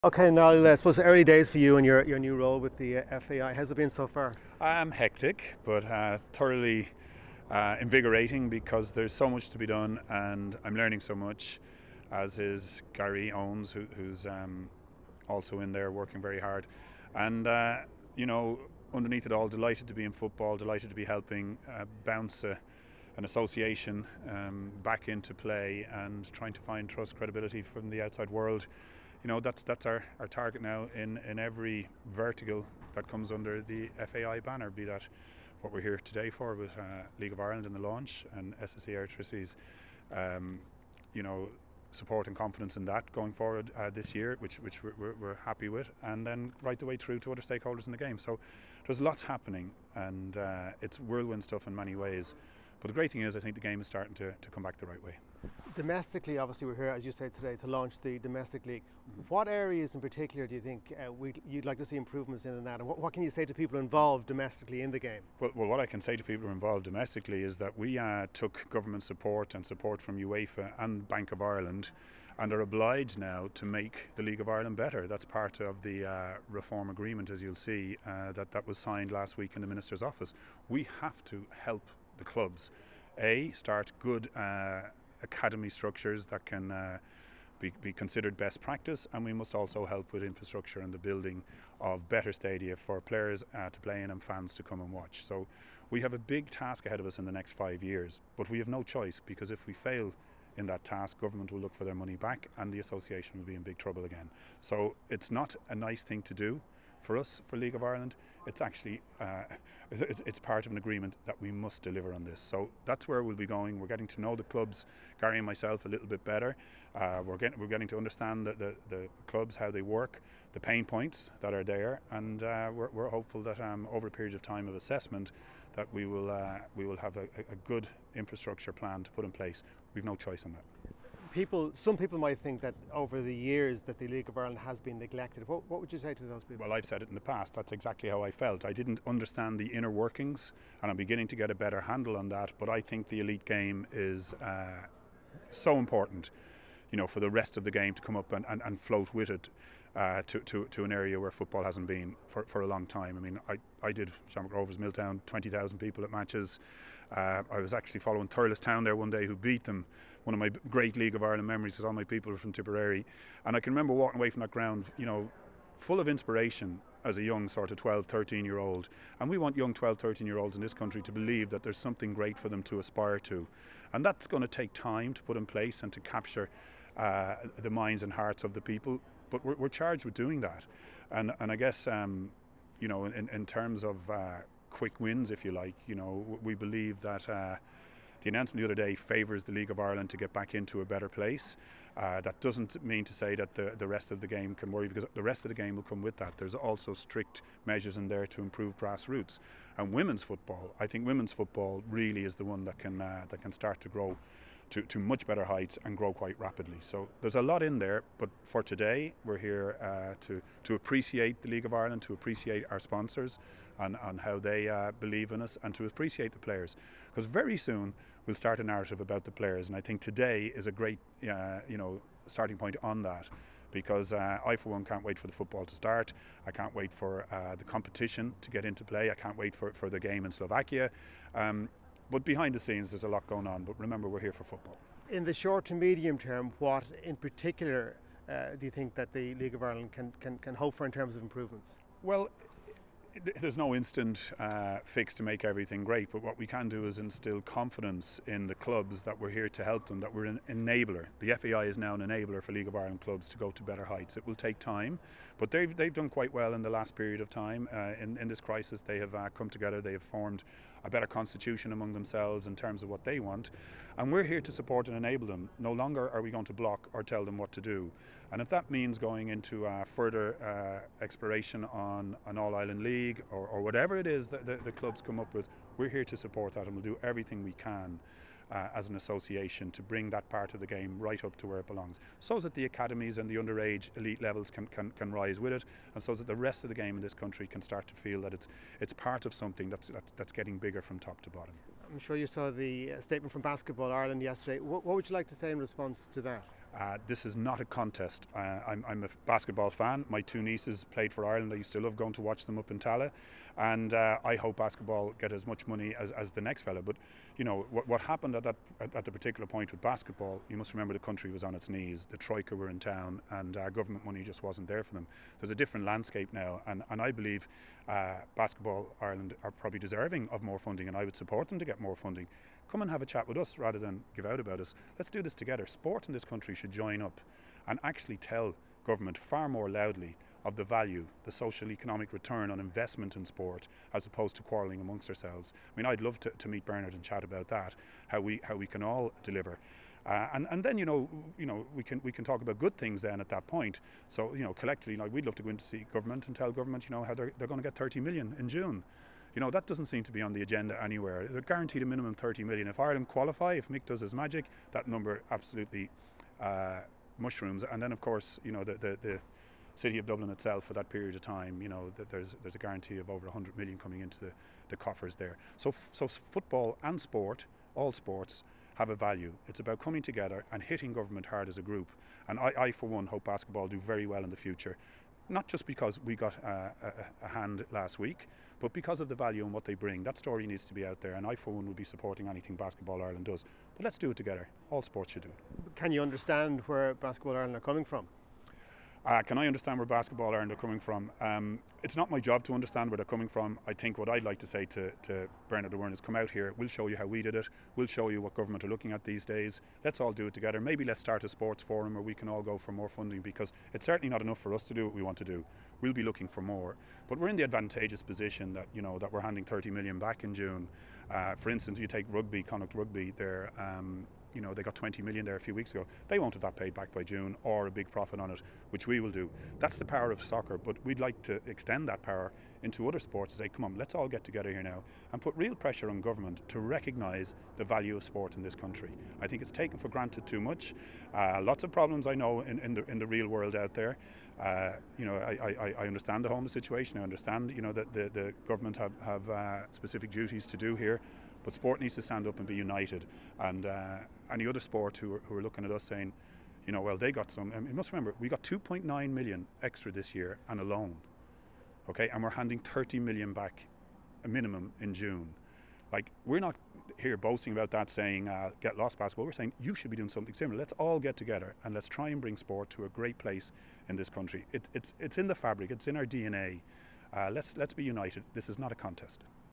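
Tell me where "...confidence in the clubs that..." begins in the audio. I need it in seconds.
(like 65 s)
247 s.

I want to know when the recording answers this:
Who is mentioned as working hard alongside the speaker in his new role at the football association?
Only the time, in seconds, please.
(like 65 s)
12 s.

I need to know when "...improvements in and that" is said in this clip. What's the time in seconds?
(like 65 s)
61 s.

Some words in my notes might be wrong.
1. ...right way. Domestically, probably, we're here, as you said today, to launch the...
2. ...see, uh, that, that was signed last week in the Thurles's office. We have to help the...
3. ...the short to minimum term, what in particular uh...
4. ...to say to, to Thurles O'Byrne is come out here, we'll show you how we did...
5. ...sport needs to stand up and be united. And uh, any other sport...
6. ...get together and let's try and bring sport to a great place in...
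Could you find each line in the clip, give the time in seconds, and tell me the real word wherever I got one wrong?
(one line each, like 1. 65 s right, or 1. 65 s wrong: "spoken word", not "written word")
1. 54 s wrong: "obviously", not "probably"
2. 77 s wrong: "Minister", not "Thurles"
3. 235 s wrong: "medium", not "minimum"
4. 394 s wrong: "Bernard", not "Thurles"
5. 441 s right
6. 460 s right.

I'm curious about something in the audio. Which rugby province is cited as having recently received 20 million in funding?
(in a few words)
Connacht.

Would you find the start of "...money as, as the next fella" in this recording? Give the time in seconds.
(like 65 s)
305 s.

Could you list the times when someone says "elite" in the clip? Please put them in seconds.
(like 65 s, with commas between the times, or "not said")
143 s, 283 s.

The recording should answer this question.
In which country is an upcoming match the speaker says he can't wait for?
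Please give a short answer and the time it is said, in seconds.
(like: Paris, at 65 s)
Slovakia, at 230 s.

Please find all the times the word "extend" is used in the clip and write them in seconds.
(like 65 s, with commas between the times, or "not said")
421 s.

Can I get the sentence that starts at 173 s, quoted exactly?
And that's going to take time to put in place and to capture uh, the minds and hearts of the people.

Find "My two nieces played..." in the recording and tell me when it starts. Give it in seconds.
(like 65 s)
300 s.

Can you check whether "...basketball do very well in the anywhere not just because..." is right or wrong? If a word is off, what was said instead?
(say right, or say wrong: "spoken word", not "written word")
wrong: "future", not "anywhere".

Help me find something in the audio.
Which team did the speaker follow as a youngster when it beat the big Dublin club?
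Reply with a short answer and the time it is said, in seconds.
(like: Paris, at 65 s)
Thurles Town, at 158 s.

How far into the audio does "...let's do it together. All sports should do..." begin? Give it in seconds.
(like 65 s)
383 s.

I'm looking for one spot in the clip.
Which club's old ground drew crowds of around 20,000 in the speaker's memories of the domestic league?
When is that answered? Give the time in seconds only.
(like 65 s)
154 s.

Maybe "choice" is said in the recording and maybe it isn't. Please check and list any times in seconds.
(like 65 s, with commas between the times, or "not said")
98 s, 130 s.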